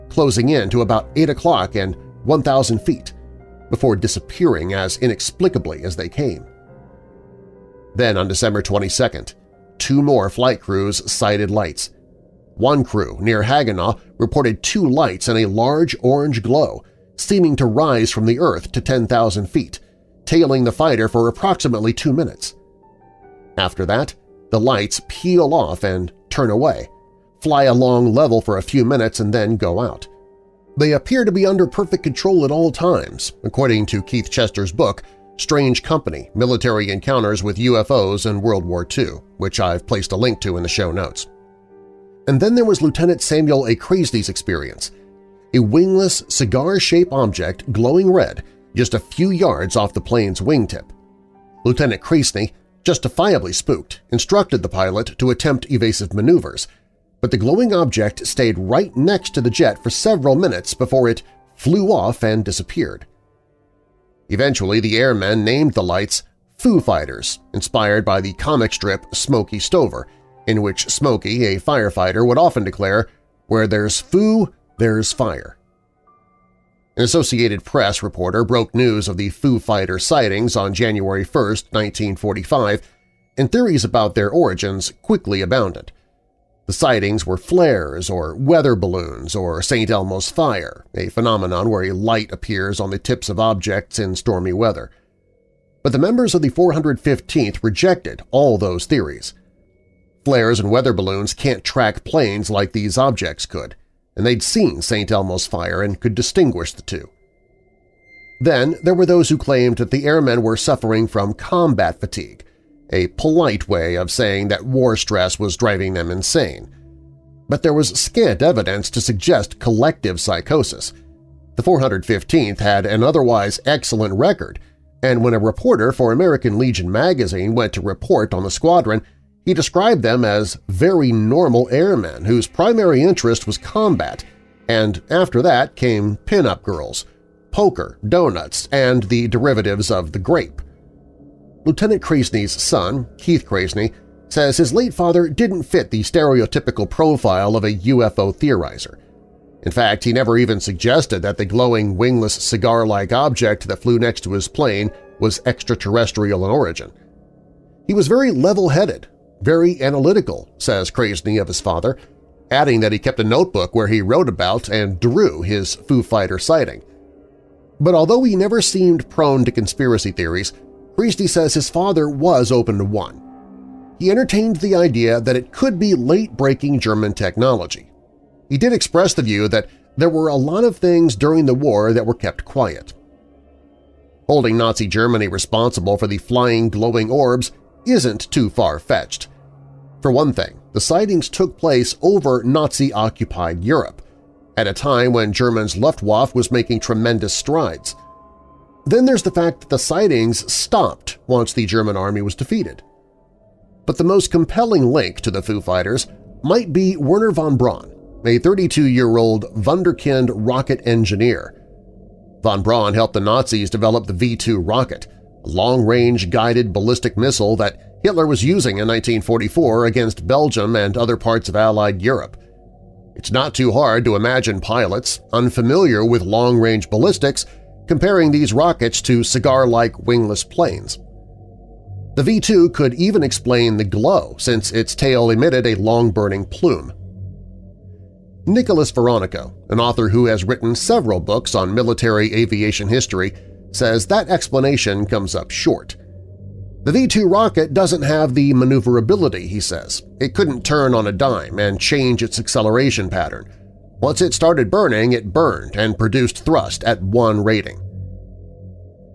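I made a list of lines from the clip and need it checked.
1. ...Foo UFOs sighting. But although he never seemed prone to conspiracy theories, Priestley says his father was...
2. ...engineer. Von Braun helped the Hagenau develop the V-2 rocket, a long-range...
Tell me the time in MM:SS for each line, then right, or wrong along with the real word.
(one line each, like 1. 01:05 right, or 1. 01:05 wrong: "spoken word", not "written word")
1. 02:45 wrong: "Fighter", not "UFOs"
2. 03:30 wrong: "Nazis", not "Hagenau".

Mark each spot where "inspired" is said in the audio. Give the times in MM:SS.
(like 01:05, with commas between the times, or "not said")
01:07.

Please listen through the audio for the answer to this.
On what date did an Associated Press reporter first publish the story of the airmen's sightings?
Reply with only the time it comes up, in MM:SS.
01:20.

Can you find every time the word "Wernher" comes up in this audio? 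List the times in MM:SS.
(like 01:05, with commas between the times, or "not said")
03:26.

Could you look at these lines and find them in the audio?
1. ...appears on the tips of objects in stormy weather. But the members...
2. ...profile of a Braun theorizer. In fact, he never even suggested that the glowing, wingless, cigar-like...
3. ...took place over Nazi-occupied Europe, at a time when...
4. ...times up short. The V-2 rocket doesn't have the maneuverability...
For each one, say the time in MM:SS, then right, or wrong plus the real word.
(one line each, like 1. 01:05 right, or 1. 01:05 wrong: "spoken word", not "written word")
1. 01:32 right
2. 02:26 wrong: "UFO", not "Braun"
3. 03:11 right
4. 04:05 wrong: "comes", not "times".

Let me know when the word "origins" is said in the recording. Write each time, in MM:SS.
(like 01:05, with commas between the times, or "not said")
01:24, 02:36.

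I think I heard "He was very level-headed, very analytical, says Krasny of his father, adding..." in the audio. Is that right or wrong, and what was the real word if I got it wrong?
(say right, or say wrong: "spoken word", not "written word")
right.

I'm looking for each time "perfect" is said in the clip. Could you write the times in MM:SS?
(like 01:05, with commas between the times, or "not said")
00:31.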